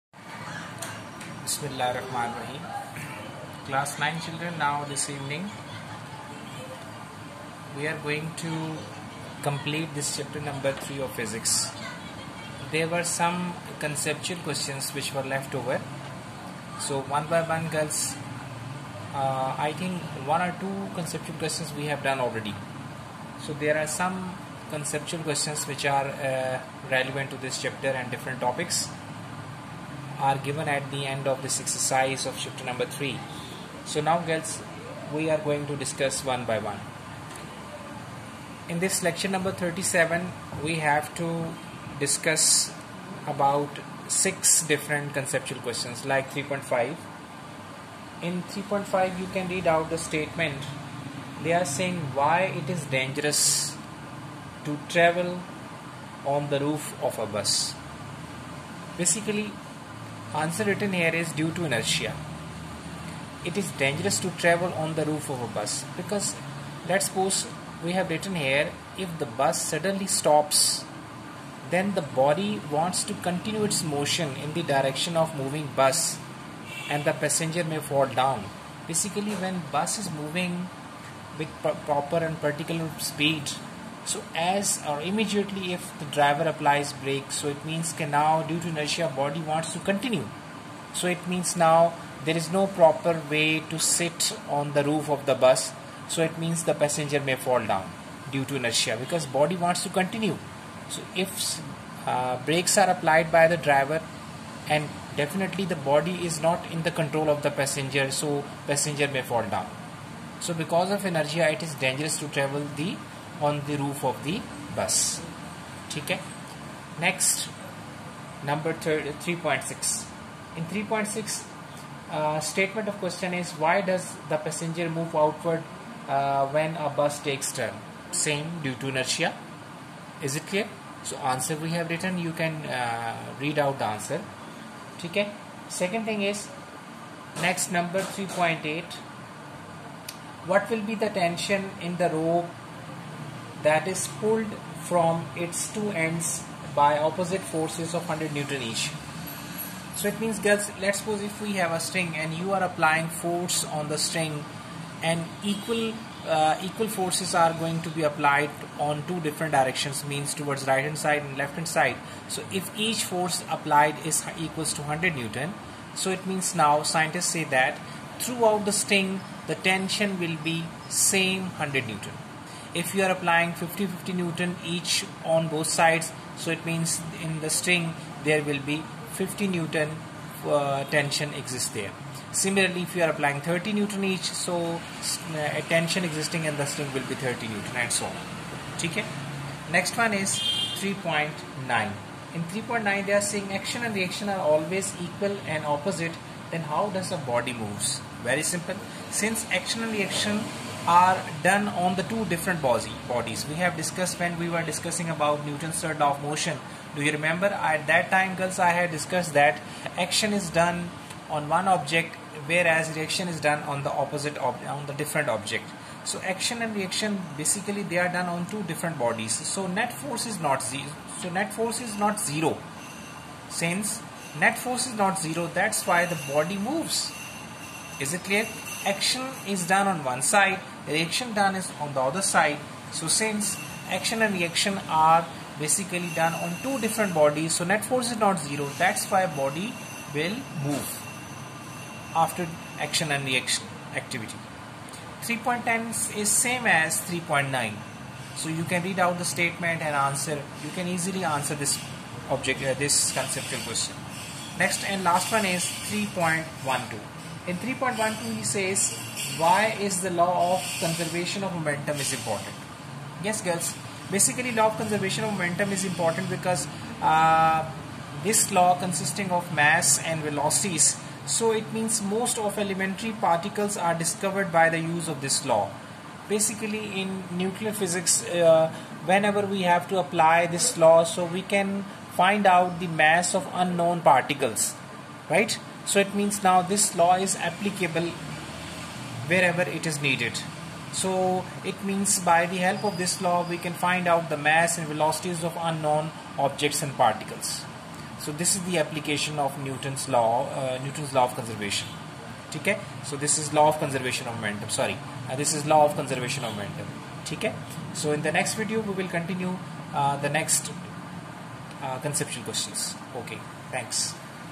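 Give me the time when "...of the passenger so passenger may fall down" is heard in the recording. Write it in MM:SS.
01:47.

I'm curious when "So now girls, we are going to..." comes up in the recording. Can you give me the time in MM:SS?
00:33.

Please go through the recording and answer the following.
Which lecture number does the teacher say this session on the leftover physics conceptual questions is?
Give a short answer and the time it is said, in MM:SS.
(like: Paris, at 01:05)
37, at 00:39.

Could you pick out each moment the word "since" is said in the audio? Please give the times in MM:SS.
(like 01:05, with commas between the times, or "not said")
03:19, 03:43, 03:53.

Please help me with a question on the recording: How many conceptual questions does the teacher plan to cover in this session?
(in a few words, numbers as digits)
6.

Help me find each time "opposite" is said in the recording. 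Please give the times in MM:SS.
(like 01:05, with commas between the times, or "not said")
02:26, 03:15, 03:33.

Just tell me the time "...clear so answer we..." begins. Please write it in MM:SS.
02:10.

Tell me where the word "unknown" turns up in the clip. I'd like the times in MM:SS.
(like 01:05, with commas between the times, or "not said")
04:43, 04:55.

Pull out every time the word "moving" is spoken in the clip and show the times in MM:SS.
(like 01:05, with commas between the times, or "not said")
01:15, 01:20.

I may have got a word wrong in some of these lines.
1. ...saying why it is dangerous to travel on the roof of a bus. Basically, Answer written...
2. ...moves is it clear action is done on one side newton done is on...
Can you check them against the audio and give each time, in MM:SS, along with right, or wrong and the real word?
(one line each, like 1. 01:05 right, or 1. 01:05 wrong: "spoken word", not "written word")
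1. 00:51 right
2. 03:46 wrong: "reaction", not "newton".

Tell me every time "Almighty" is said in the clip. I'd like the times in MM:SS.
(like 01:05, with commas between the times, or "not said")
not said.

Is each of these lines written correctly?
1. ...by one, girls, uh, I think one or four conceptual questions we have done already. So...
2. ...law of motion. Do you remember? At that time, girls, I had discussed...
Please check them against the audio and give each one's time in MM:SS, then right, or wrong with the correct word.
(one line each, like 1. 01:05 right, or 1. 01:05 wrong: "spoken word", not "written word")
1. 00:17 wrong: "two", not "four"
2. 03:25 right.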